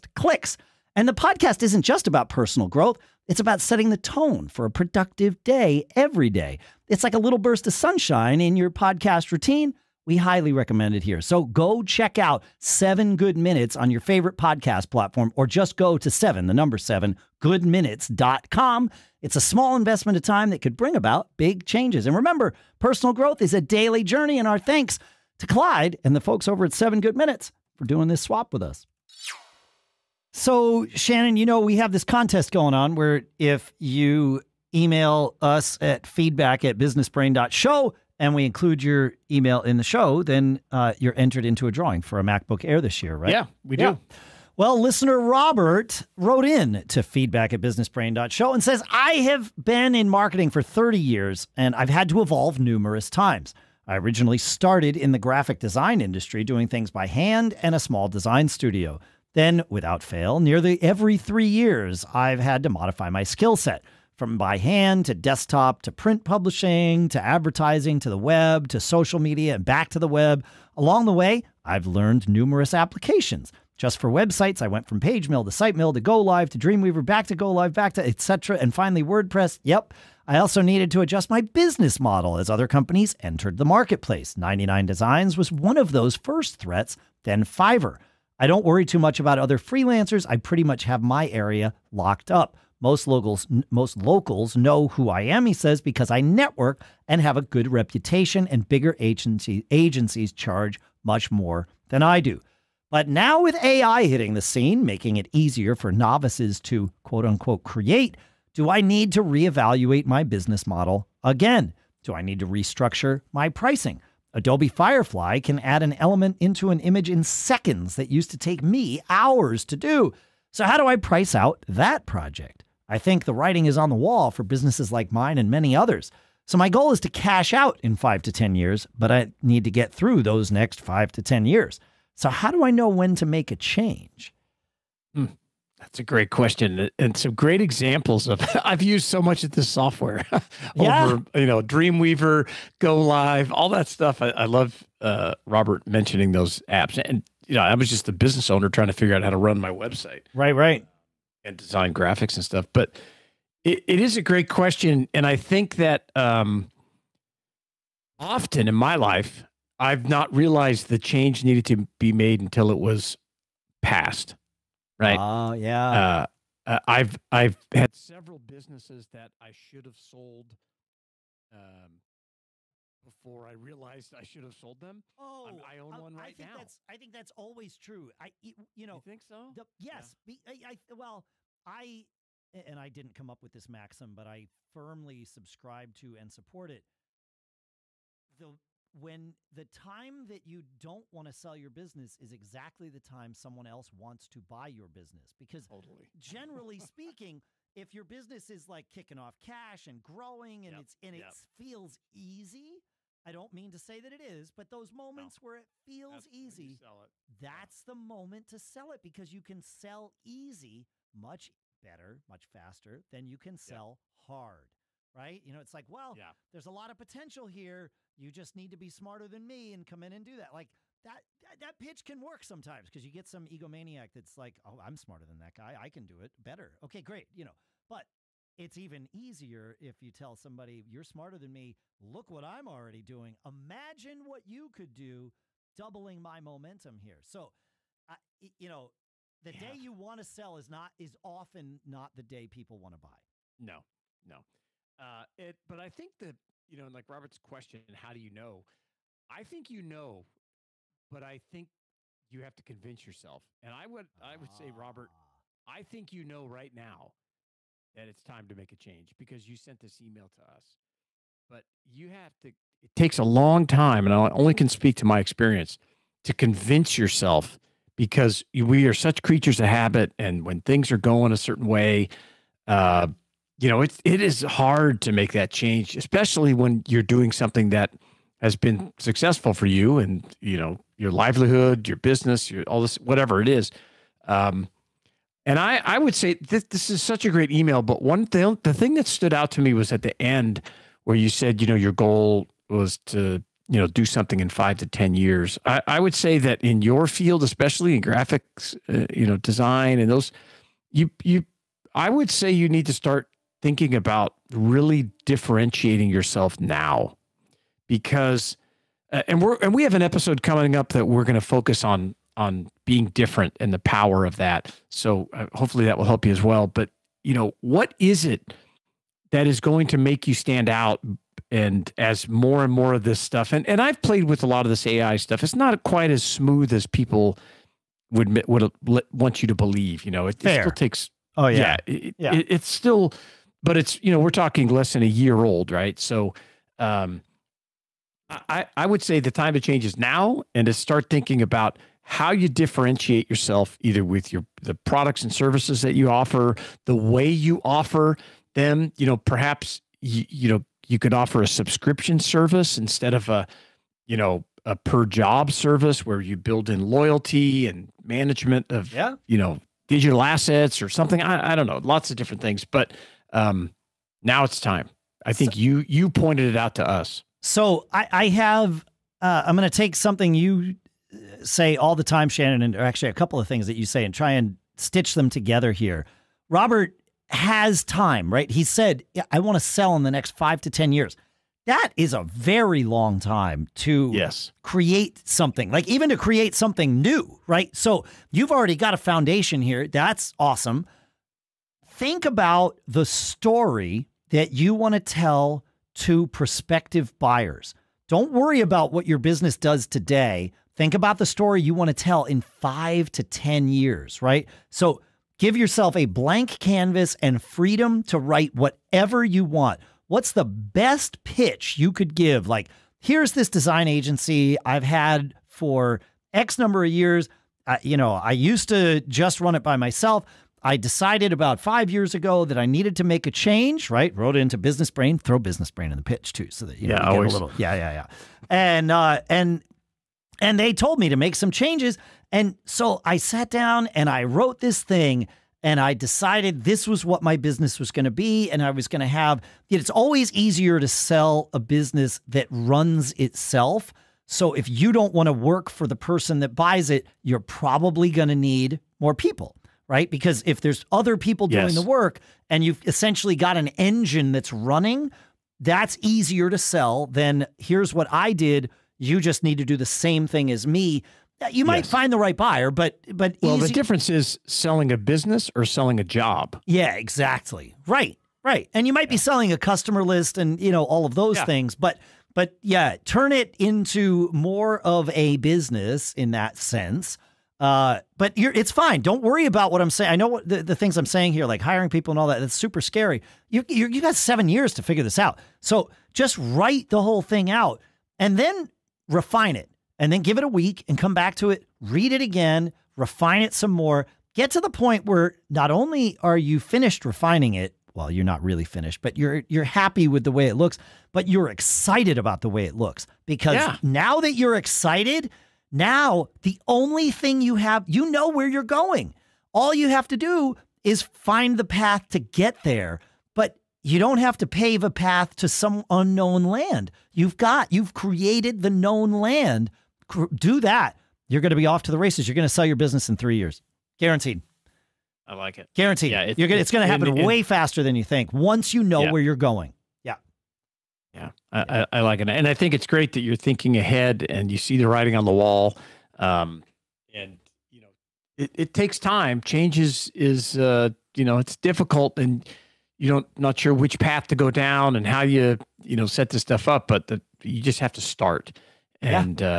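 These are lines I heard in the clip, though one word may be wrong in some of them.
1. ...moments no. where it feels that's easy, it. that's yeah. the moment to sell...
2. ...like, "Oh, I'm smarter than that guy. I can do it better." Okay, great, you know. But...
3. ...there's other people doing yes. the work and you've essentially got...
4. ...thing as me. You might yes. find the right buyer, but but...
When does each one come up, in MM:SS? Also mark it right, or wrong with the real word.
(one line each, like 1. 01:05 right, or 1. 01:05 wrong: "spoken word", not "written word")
1. 03:24 right
2. 03:44 right
3. 07:30 right
4. 07:40 right.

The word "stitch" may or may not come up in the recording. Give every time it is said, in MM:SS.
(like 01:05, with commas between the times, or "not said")
06:14.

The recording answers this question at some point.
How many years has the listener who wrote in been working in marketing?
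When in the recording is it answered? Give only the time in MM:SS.
00:50.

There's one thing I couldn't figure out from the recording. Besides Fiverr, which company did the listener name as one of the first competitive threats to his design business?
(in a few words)
99 Designs.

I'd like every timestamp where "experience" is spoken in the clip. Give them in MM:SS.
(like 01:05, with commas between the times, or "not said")
04:25.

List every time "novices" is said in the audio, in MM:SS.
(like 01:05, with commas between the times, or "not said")
01:45.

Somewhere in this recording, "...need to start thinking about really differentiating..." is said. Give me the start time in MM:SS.
05:02.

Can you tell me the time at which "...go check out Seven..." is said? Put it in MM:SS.
00:11.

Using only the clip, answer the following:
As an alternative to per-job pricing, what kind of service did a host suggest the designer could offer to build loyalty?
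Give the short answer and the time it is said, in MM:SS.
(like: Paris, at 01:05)
subscription service, at 05:51.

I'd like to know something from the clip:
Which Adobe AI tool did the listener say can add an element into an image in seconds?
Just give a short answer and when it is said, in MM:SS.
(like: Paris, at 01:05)
Adobe Firefly, at 01:54.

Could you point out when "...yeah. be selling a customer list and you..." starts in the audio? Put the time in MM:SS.
07:49.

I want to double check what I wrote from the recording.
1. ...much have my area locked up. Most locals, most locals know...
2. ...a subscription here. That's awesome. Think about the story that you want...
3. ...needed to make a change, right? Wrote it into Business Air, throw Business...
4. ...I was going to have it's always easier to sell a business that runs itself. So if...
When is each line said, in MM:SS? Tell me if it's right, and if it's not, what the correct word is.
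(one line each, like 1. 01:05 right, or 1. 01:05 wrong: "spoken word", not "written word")
1. 01:30 right
2. 06:28 wrong: "foundation", not "subscription"
3. 07:02 wrong: "Brain", not "Air"
4. 07:18 right.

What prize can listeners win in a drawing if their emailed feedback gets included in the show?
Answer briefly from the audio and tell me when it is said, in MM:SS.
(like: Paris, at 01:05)
MacBook Air, at 00:42.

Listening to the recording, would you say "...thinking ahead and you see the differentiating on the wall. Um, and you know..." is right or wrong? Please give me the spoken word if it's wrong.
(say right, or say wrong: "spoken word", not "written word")
wrong: "writing", not "differentiating".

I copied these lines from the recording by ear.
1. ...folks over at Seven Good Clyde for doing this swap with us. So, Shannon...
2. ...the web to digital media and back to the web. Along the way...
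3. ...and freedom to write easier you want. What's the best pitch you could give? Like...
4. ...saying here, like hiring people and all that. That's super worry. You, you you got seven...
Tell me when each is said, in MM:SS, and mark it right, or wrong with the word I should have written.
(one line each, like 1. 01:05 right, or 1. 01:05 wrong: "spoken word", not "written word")
1. 00:26 wrong: "Minutes", not "Clyde"
2. 01:08 wrong: "social", not "digital"
3. 06:47 wrong: "whatever", not "easier"
4. 08:01 wrong: "scary", not "worry".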